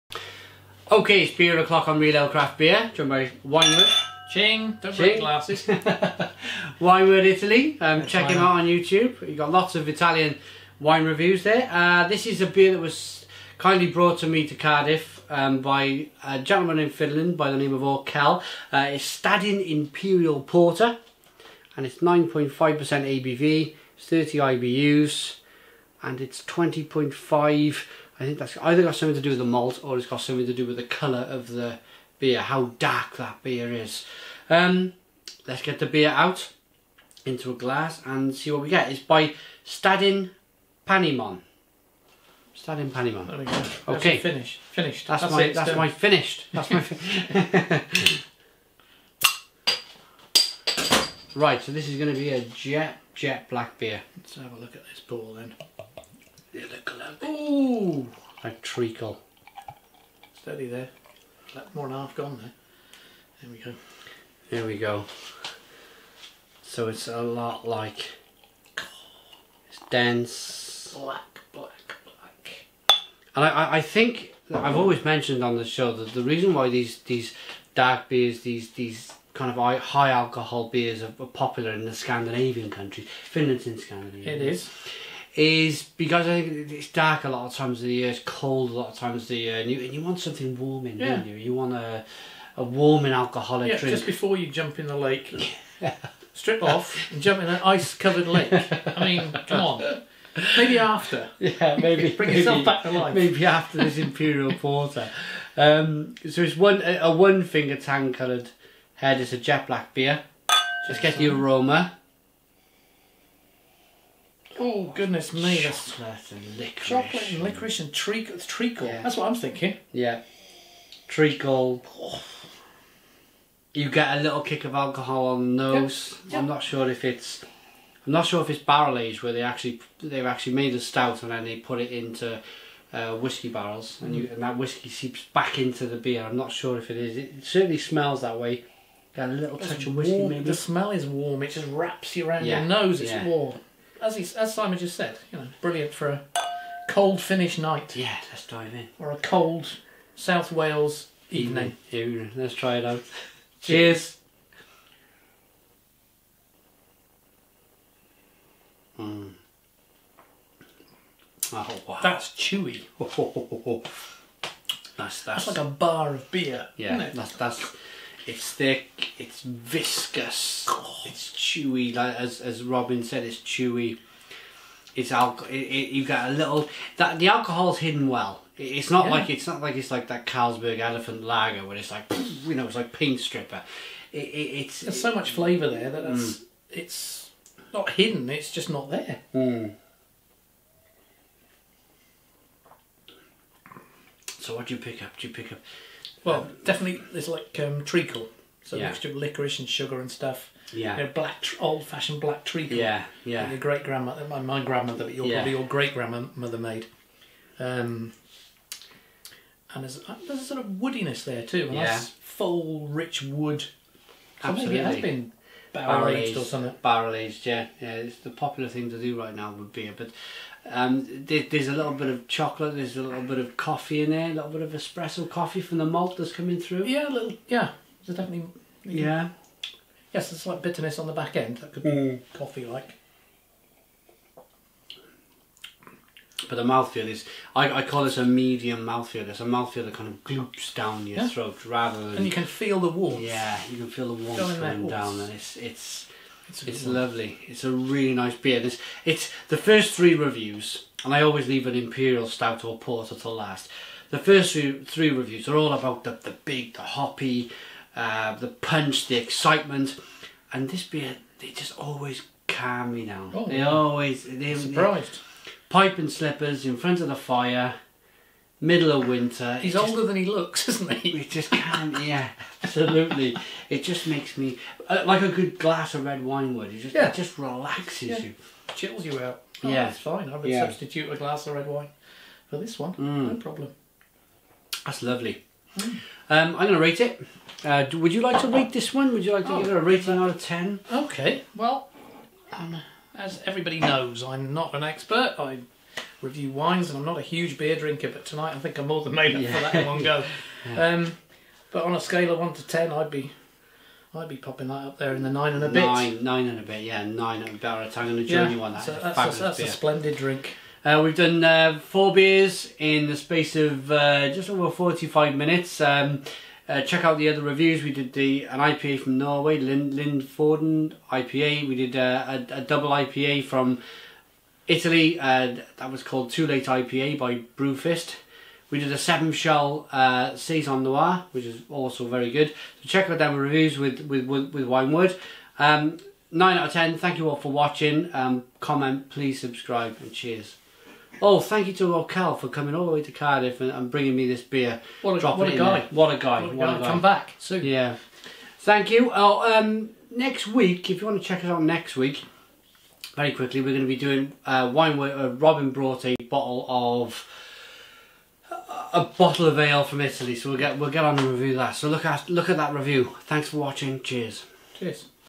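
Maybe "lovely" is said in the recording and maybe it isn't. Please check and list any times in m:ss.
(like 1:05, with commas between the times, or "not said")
4:06, 4:45.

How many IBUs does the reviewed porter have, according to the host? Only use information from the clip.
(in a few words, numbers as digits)
30.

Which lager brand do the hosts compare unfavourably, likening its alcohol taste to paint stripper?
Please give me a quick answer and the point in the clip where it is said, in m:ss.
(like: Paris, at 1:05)
Carlsberg Elephant, at 3:00.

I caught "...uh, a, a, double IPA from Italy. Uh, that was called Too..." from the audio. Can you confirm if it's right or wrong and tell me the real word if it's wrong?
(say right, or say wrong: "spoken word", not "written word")
right.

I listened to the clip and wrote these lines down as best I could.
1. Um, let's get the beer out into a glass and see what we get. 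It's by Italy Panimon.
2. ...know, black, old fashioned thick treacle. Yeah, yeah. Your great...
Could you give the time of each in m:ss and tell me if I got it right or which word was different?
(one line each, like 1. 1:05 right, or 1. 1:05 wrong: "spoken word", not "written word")
1. 0:34 wrong: "Stadin", not "Italy"
2. 3:21 wrong: "black", not "thick".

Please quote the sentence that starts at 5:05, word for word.
Nine, nine and a bit, yeah, nine and a bit.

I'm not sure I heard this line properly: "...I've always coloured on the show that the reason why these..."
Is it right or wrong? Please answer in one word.
wrong.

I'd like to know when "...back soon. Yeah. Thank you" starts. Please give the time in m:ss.
5:47.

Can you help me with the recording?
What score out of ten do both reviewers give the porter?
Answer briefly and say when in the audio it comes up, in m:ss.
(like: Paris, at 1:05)
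9, at 5:36.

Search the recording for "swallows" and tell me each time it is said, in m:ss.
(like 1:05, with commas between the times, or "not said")
not said.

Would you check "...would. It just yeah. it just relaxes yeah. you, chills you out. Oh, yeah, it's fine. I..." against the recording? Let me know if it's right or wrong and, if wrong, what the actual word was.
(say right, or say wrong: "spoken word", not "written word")
right.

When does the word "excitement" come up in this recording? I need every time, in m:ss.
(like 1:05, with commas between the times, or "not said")
4:19.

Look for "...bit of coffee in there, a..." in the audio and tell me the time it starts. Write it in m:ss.
3:43.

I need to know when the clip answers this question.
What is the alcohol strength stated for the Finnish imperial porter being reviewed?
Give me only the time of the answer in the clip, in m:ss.
0:21.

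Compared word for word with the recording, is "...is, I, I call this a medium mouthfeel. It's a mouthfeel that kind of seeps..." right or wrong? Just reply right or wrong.
wrong.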